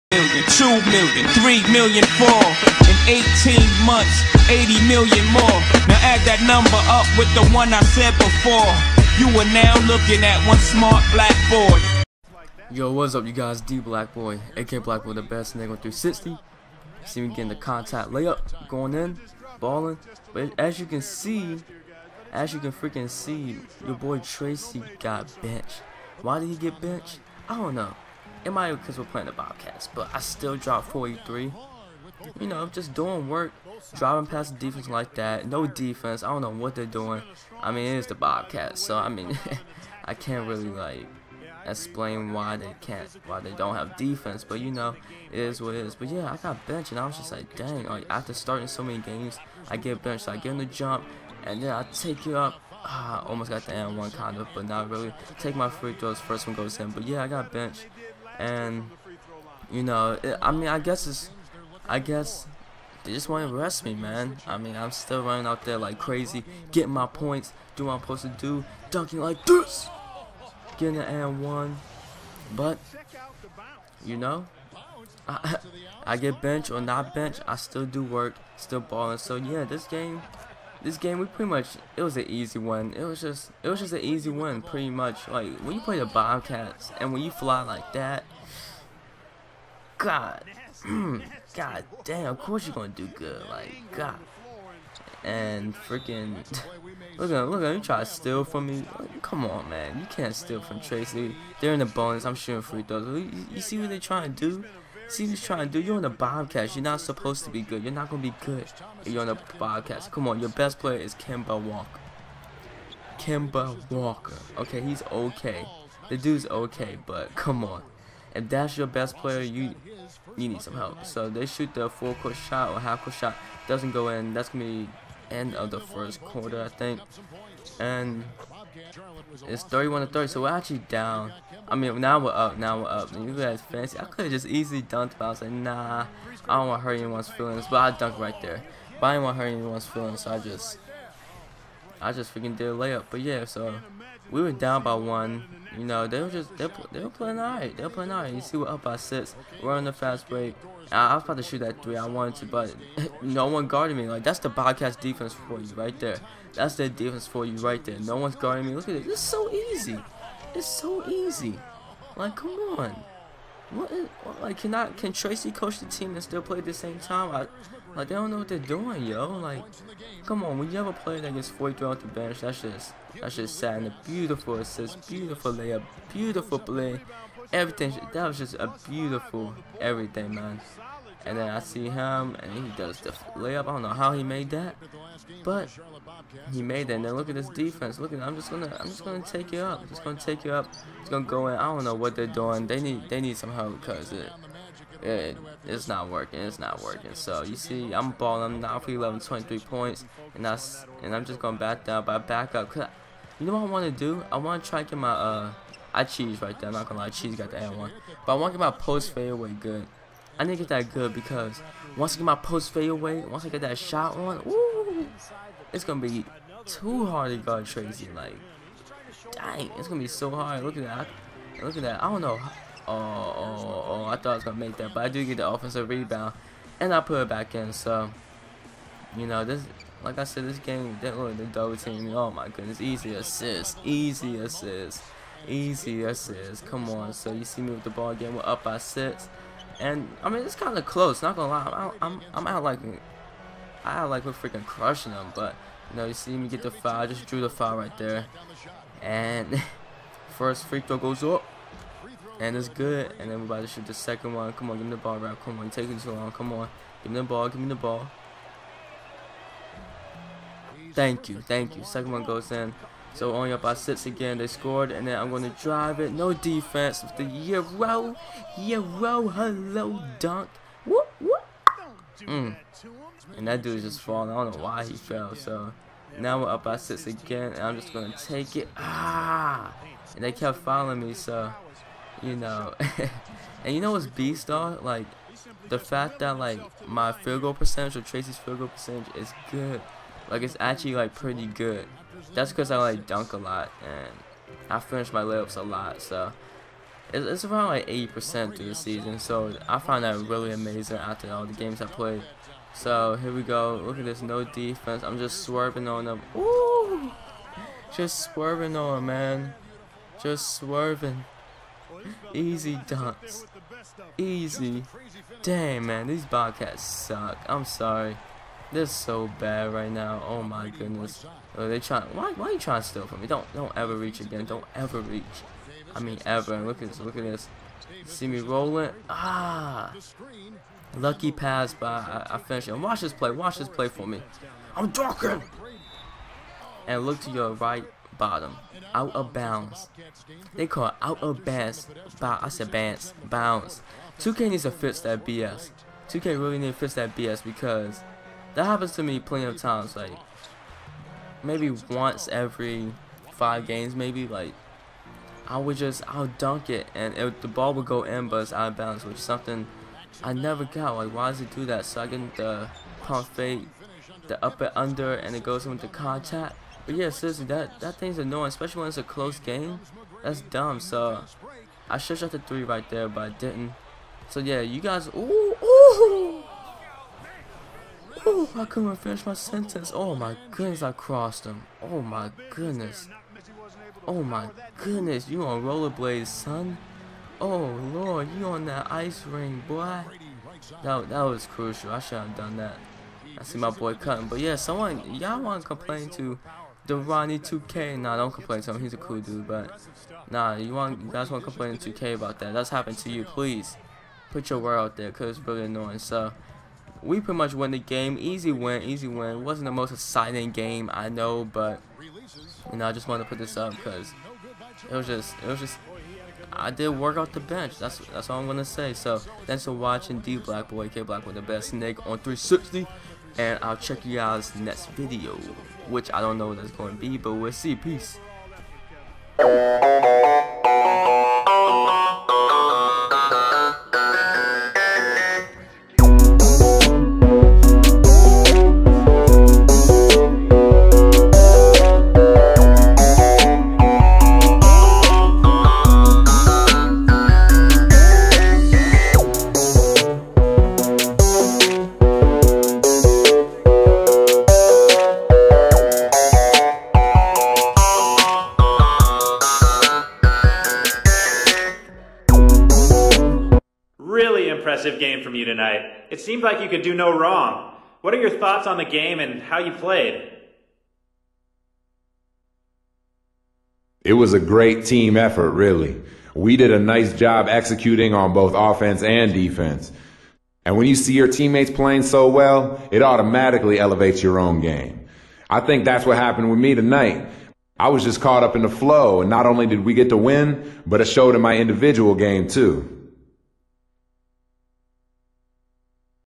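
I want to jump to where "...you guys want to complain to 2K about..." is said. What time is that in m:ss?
6:41.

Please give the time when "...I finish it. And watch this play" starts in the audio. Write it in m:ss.
5:32.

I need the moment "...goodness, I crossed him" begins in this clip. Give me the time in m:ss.
6:20.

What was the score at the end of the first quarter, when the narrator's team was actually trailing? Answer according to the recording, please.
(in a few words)
31 to 30.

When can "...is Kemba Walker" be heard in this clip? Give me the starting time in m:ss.
1:51.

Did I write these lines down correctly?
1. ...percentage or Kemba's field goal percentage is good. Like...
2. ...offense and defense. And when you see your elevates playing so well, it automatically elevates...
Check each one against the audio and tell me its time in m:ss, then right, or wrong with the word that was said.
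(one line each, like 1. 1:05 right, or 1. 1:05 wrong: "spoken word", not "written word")
1. 4:47 wrong: "Tracy", not "Kemba"
2. 7:58 wrong: "teammates", not "elevates".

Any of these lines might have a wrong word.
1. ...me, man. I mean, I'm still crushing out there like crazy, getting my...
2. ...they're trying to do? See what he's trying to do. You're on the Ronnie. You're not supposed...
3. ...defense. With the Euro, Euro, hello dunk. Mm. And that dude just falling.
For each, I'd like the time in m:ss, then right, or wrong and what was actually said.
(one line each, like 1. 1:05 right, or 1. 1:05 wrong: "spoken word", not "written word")
1. 1:03 wrong: "running", not "crushing"
2. 1:43 wrong: "Bobcats", not "Ronnie"
3. 4:26 right.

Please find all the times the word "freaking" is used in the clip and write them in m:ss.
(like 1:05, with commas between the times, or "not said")
0:22, 1:35, 2:22, 4:04.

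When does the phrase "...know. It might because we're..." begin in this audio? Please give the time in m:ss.
0:27.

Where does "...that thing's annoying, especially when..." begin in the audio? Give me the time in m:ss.
6:07.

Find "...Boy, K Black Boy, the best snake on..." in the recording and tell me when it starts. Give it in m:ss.
7:00.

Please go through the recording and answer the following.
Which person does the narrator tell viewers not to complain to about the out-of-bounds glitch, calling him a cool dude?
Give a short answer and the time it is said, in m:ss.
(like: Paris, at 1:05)
Ronnie 2K, at 6:36.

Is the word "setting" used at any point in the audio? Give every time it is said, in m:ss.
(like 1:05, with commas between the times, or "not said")
not said.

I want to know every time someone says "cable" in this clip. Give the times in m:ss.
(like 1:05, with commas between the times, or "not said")
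not said.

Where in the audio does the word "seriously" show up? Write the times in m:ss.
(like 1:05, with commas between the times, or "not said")
6:07.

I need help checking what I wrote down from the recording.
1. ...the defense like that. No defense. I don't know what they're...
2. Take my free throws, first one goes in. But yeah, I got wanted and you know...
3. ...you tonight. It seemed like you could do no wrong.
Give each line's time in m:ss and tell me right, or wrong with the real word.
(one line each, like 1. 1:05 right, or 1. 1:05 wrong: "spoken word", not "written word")
1. 0:34 right
2. 0:55 wrong: "benched", not "wanted"
3. 7:45 right.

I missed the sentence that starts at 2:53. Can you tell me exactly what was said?
And a beautiful assist, beautiful layup, beautiful play, everything.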